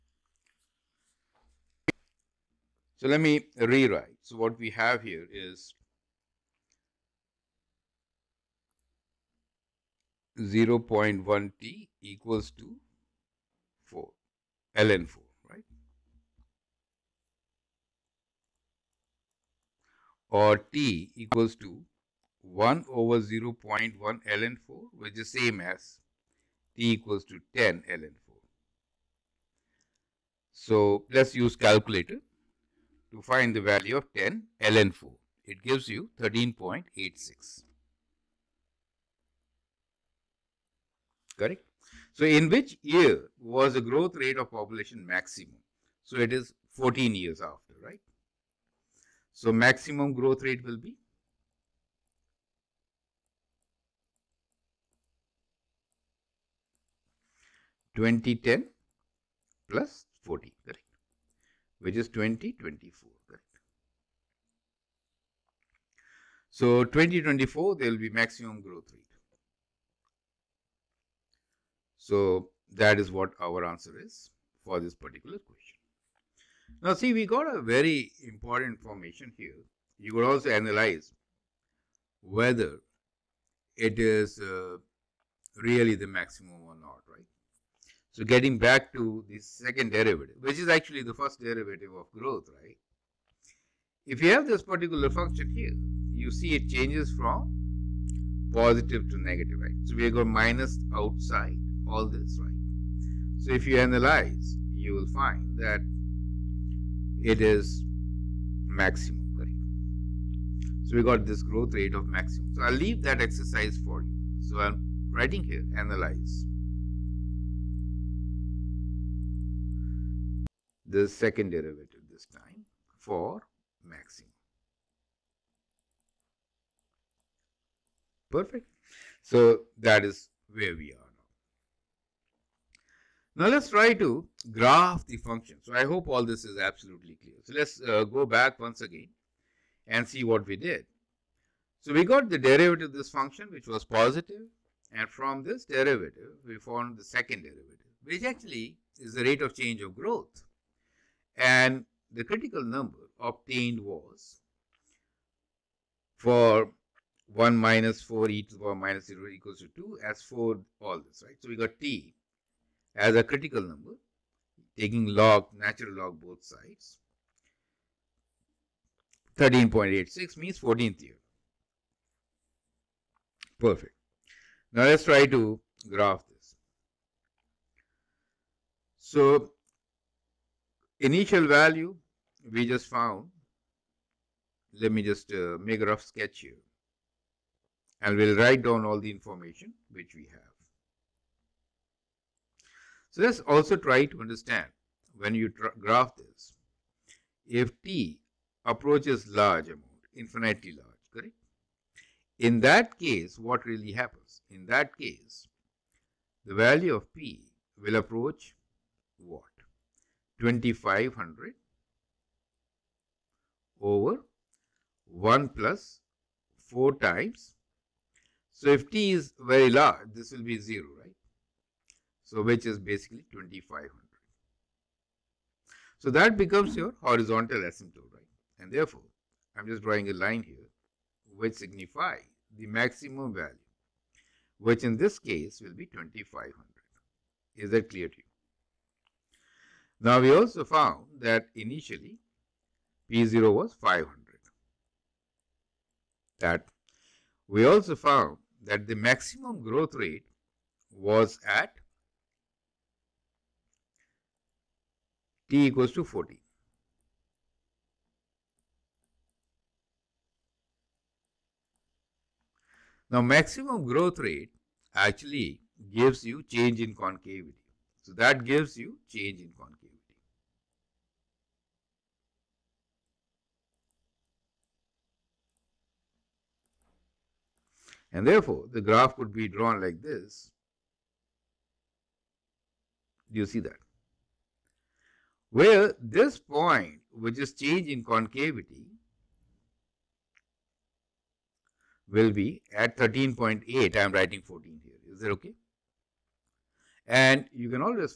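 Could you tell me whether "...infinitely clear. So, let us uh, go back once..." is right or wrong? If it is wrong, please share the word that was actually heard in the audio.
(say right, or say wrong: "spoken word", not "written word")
wrong: "absolutely", not "infinitely".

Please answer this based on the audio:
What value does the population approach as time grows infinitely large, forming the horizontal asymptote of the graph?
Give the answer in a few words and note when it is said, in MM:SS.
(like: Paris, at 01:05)
2500, at 03:42.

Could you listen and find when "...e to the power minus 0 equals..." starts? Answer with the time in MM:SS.
02:38.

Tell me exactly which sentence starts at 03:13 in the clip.
So let's also try to understand when you graph this.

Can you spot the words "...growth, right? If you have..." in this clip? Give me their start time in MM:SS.
01:32.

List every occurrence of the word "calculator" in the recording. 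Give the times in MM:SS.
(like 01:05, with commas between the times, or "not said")
00:31.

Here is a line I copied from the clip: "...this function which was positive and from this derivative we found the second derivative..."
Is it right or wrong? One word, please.
right.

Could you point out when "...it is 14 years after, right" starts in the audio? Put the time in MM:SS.
00:46.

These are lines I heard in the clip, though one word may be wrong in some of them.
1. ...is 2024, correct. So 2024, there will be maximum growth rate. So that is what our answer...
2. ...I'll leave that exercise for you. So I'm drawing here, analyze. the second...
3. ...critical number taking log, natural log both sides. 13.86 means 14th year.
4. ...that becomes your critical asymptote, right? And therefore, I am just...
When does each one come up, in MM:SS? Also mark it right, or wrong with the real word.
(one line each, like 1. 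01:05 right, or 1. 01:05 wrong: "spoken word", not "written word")
1. 01:01 right
2. 01:52 wrong: "writing", not "drawing"
3. 02:43 right
4. 03:46 wrong: "horizontal", not "critical".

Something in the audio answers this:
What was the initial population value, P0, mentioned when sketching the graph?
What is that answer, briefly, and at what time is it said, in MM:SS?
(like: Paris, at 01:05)
500, at 04:03.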